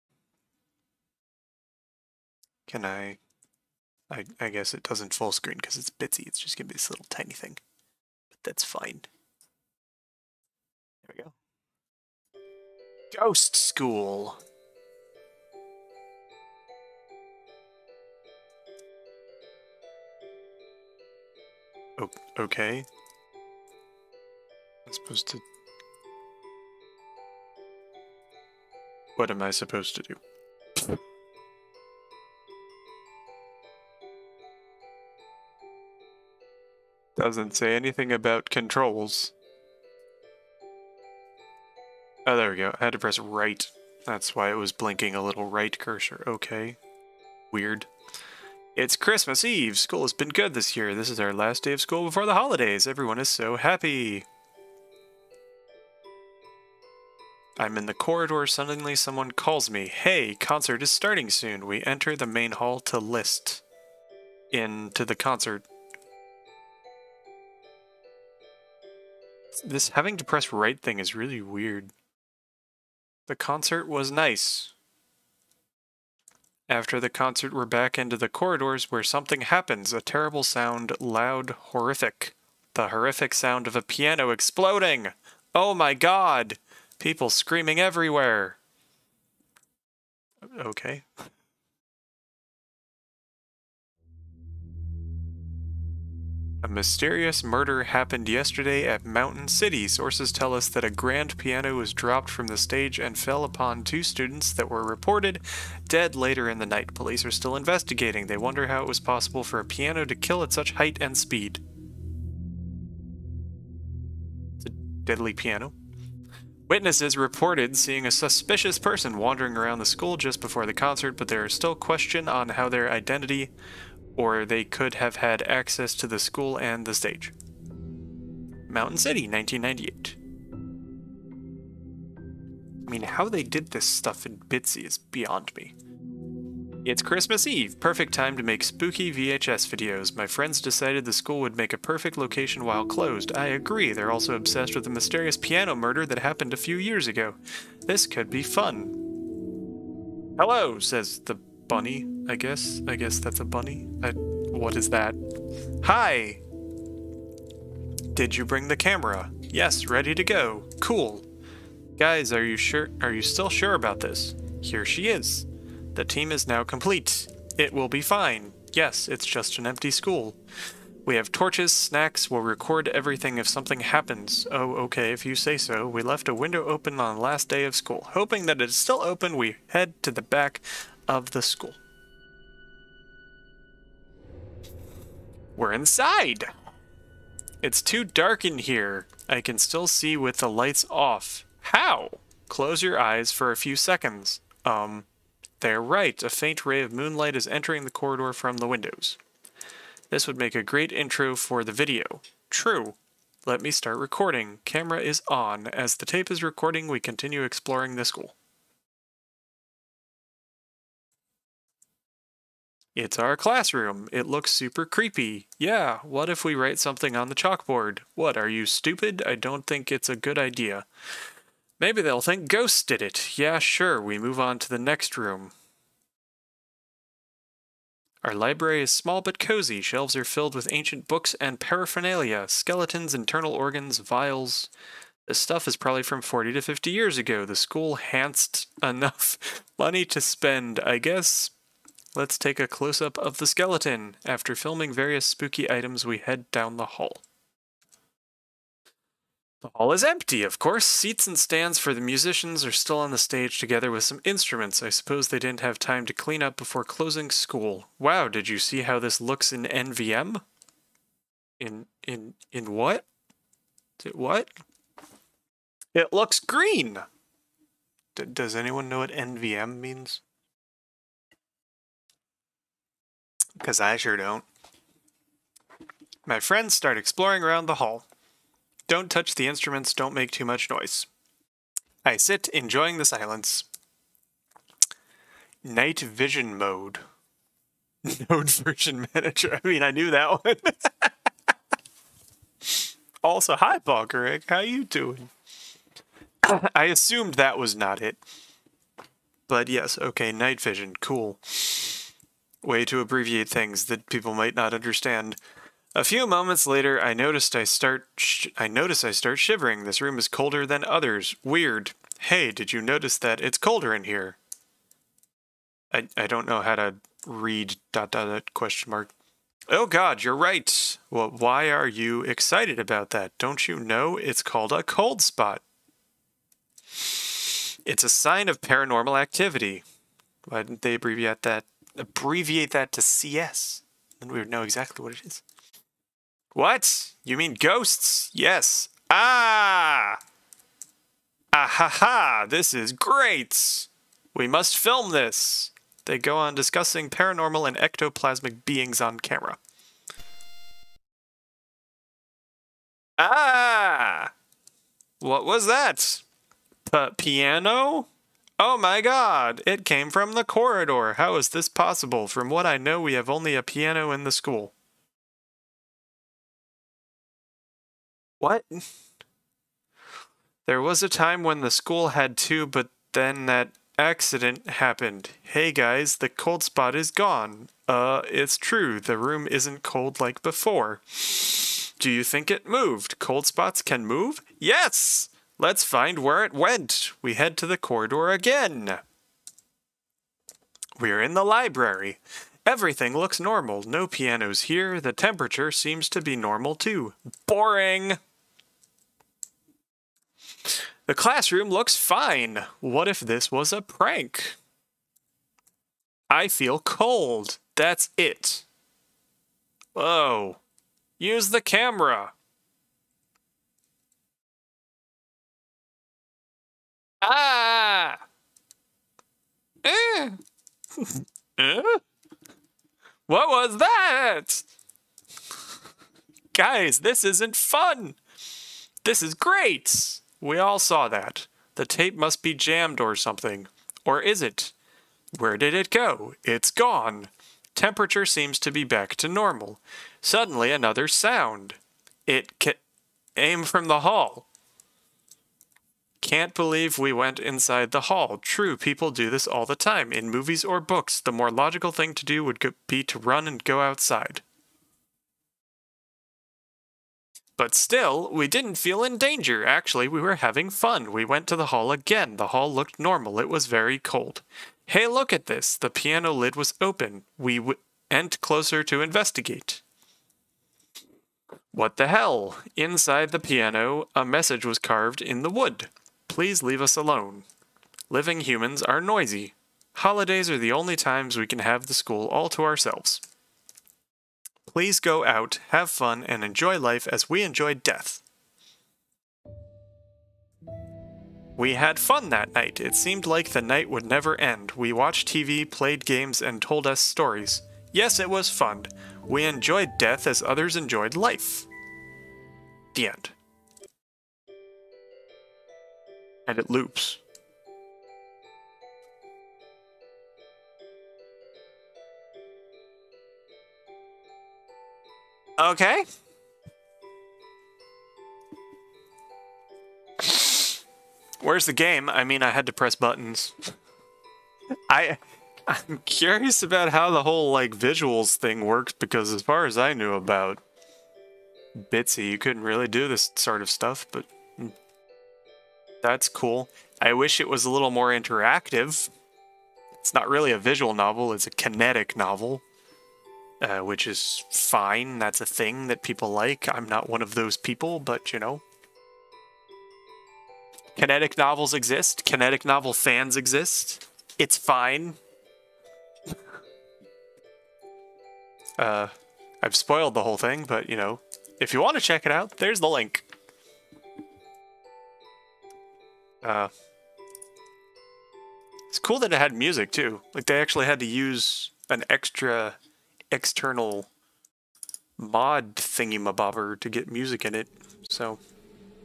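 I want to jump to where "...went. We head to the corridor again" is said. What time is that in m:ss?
6:26.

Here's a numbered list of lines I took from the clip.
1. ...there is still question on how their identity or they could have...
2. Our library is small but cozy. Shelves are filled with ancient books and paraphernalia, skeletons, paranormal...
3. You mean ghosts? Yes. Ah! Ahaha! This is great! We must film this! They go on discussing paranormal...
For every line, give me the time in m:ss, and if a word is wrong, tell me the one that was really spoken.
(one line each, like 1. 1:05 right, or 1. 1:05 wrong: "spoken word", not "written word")
1. 2:01 right
2. 3:48 wrong: "internal", not "paranormal"
3. 5:37 right.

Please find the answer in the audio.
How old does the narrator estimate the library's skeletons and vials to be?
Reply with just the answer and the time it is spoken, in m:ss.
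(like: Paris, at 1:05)
40 to 50 years, at 3:56.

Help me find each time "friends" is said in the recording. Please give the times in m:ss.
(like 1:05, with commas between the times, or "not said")
2:20, 4:36.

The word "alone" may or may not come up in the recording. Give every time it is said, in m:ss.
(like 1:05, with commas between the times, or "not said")
7:56.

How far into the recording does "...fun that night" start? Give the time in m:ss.
8:11.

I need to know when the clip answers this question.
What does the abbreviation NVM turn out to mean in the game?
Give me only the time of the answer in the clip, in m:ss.
4:45.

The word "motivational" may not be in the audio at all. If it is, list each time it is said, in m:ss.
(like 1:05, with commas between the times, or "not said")
not said.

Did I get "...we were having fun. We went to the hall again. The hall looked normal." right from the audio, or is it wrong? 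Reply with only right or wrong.
right.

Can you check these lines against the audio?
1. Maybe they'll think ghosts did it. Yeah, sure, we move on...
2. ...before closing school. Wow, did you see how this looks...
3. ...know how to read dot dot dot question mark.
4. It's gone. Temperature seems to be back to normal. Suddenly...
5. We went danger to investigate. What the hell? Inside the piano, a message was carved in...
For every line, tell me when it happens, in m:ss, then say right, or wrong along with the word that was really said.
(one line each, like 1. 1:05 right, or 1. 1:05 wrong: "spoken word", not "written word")
1. 3:41 right
2. 4:16 right
3. 5:16 right
4. 7:16 right
5. 7:47 wrong: "closer", not "danger".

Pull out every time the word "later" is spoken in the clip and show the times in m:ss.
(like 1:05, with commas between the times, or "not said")
1:46, 5:06.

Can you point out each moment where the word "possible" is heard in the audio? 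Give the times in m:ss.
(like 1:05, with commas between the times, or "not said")
1:48, 6:01.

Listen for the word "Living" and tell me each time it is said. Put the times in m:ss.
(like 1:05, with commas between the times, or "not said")
7:58.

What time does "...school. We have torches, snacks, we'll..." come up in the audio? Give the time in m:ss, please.
2:49.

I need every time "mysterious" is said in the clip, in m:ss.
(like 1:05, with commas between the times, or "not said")
1:36, 2:24.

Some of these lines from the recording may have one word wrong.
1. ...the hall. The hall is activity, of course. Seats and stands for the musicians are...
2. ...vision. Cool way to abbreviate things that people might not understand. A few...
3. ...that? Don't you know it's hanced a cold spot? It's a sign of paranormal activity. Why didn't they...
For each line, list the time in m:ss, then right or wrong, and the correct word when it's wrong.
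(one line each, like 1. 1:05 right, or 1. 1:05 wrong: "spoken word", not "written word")
1. 4:06 wrong: "empty", not "activity"
2. 5:00 right
3. 5:23 wrong: "called", not "hanced".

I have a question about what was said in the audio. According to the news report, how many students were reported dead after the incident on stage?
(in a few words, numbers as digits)
2.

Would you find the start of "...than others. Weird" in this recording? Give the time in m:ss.
5:10.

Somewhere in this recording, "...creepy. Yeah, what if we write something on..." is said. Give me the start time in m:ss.
3:34.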